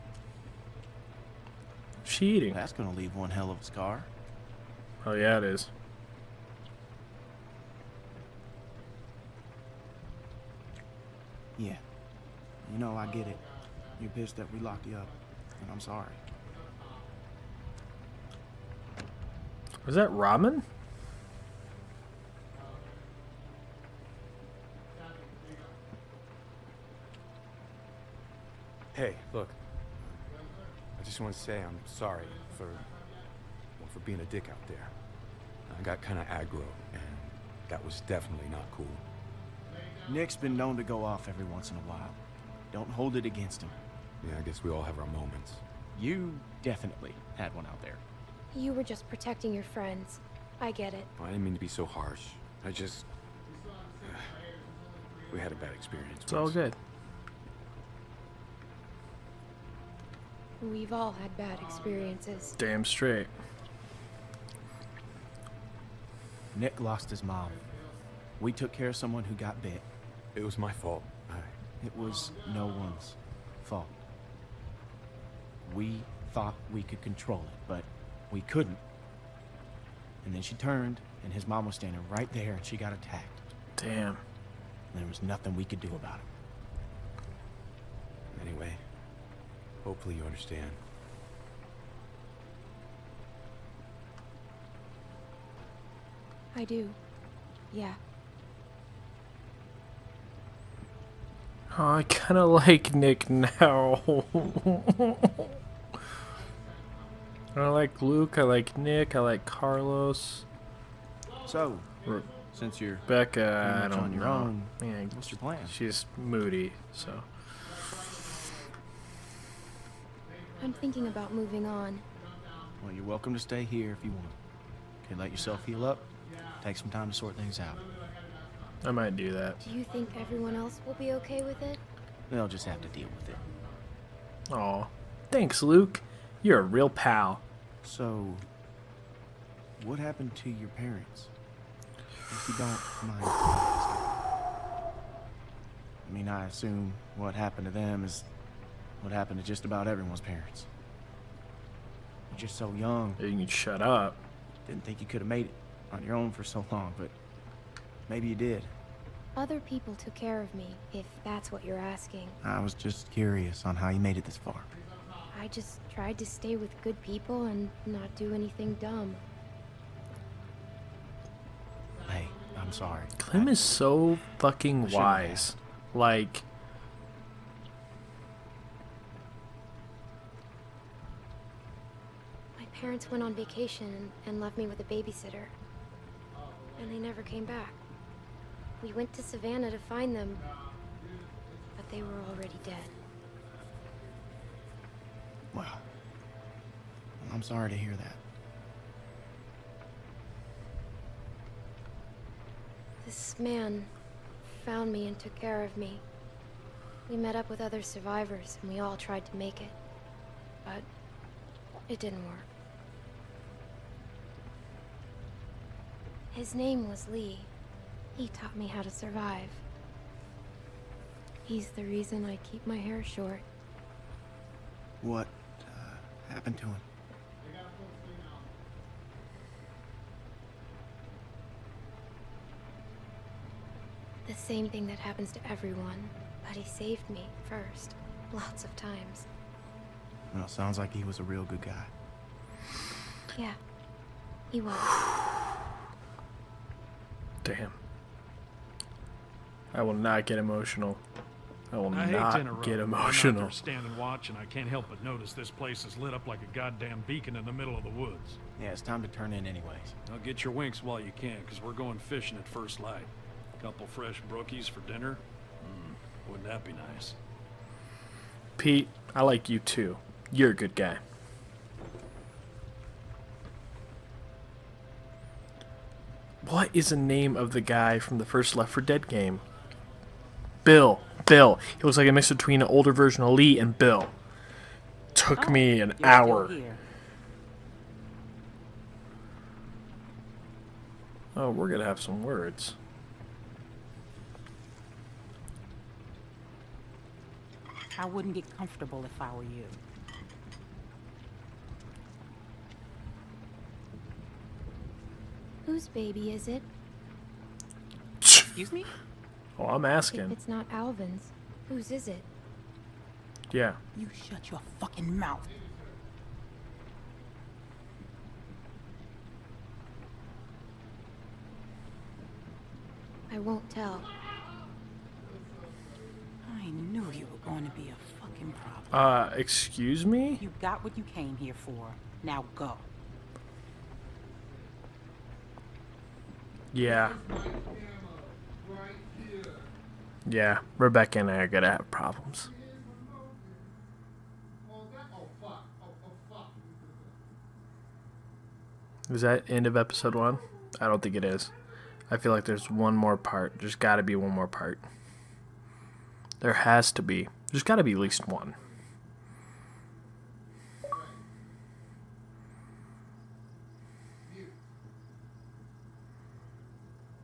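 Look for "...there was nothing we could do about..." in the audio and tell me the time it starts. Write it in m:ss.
1:25.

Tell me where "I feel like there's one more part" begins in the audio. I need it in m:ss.
5:52.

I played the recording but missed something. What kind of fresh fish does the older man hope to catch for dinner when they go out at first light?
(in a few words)
Brookies.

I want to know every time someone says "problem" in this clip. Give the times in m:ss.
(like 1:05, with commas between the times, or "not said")
5:28, 5:41.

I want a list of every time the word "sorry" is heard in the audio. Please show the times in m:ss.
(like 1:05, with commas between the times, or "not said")
0:15, 0:31, 2:52, 3:17.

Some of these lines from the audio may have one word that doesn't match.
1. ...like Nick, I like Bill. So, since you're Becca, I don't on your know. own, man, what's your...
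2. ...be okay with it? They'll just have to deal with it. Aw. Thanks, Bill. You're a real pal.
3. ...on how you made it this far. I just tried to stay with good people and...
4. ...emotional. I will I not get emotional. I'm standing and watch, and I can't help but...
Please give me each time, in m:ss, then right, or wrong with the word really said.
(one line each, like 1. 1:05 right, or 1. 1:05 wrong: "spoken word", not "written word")
1. 1:48 wrong: "Carlos", not "Bill"
2. 2:10 wrong: "Luke", not "Bill"
3. 2:43 right
4. 4:10 right.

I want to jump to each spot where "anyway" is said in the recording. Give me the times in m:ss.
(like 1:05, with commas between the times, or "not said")
1:28, 4:19.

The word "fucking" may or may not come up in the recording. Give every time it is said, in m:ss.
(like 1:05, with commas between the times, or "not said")
2:54, 5:14, 5:28.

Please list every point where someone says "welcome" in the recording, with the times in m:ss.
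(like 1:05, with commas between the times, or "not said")
2:03.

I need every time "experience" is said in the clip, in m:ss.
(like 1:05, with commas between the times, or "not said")
0:55, 1:01.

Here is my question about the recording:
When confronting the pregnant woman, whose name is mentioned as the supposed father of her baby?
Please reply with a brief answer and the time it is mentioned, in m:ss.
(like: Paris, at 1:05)
Alvin, at 5:10.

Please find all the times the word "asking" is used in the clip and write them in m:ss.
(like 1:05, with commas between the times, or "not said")
2:41, 5:09.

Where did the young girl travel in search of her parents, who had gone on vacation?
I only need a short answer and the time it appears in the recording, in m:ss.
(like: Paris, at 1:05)
Savannah, at 3:09.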